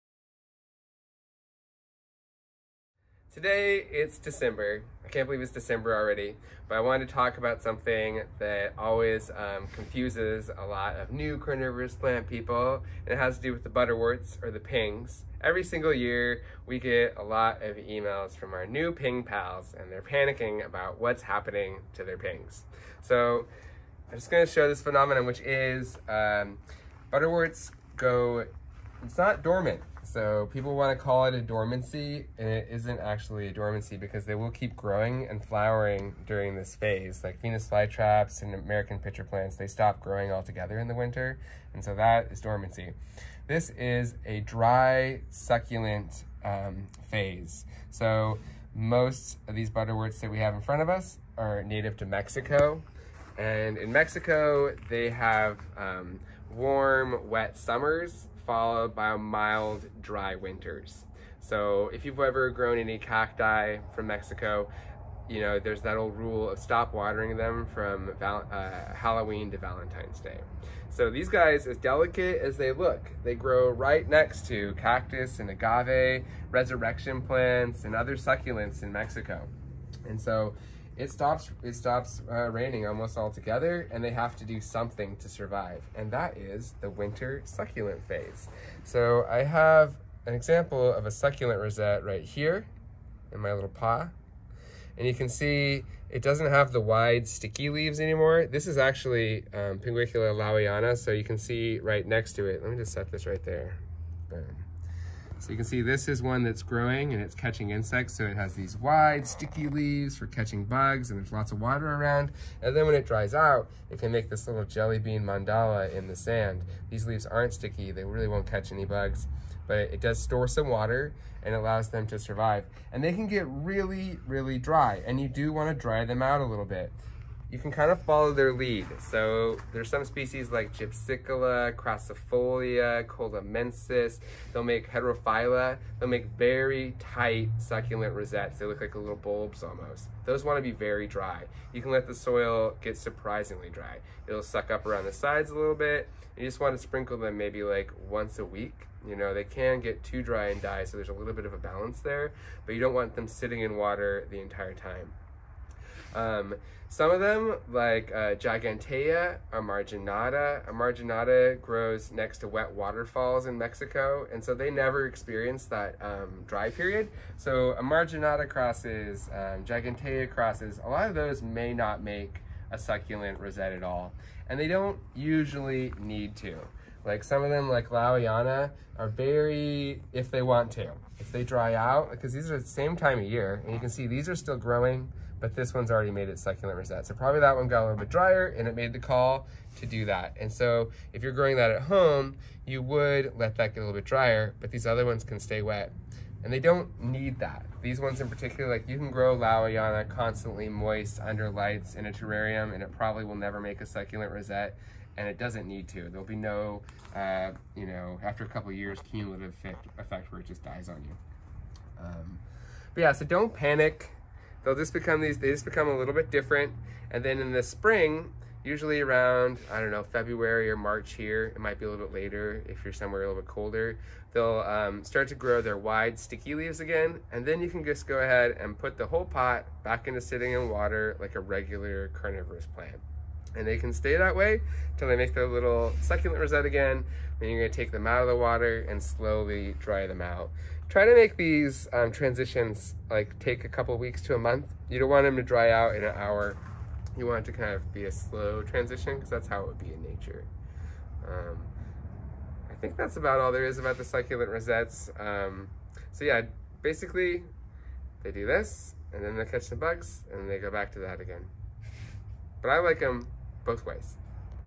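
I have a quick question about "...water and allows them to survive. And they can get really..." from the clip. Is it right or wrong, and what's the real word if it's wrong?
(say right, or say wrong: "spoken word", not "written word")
right.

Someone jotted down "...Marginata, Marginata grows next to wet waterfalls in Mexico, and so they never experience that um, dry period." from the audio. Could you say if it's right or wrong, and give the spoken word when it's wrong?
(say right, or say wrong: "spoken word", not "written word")
right.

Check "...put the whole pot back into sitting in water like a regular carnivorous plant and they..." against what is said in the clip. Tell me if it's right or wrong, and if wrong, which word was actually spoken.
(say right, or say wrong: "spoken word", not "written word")
right.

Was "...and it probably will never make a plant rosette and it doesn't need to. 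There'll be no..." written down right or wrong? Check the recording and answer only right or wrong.
wrong.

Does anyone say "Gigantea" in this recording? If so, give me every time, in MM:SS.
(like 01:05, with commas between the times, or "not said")
02:38, 02:49.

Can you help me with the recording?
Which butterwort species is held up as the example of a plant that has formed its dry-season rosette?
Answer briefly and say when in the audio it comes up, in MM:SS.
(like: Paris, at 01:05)
Pinguicula laueana, at 01:39.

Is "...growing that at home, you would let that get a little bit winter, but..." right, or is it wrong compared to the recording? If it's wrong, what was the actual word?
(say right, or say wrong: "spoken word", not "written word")
wrong: "drier", not "winter".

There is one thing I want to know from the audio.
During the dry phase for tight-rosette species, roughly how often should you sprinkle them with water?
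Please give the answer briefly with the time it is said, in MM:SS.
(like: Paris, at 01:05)
once a week, at 02:28.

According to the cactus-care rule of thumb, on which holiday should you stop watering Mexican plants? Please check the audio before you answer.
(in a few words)
Valentine's Day.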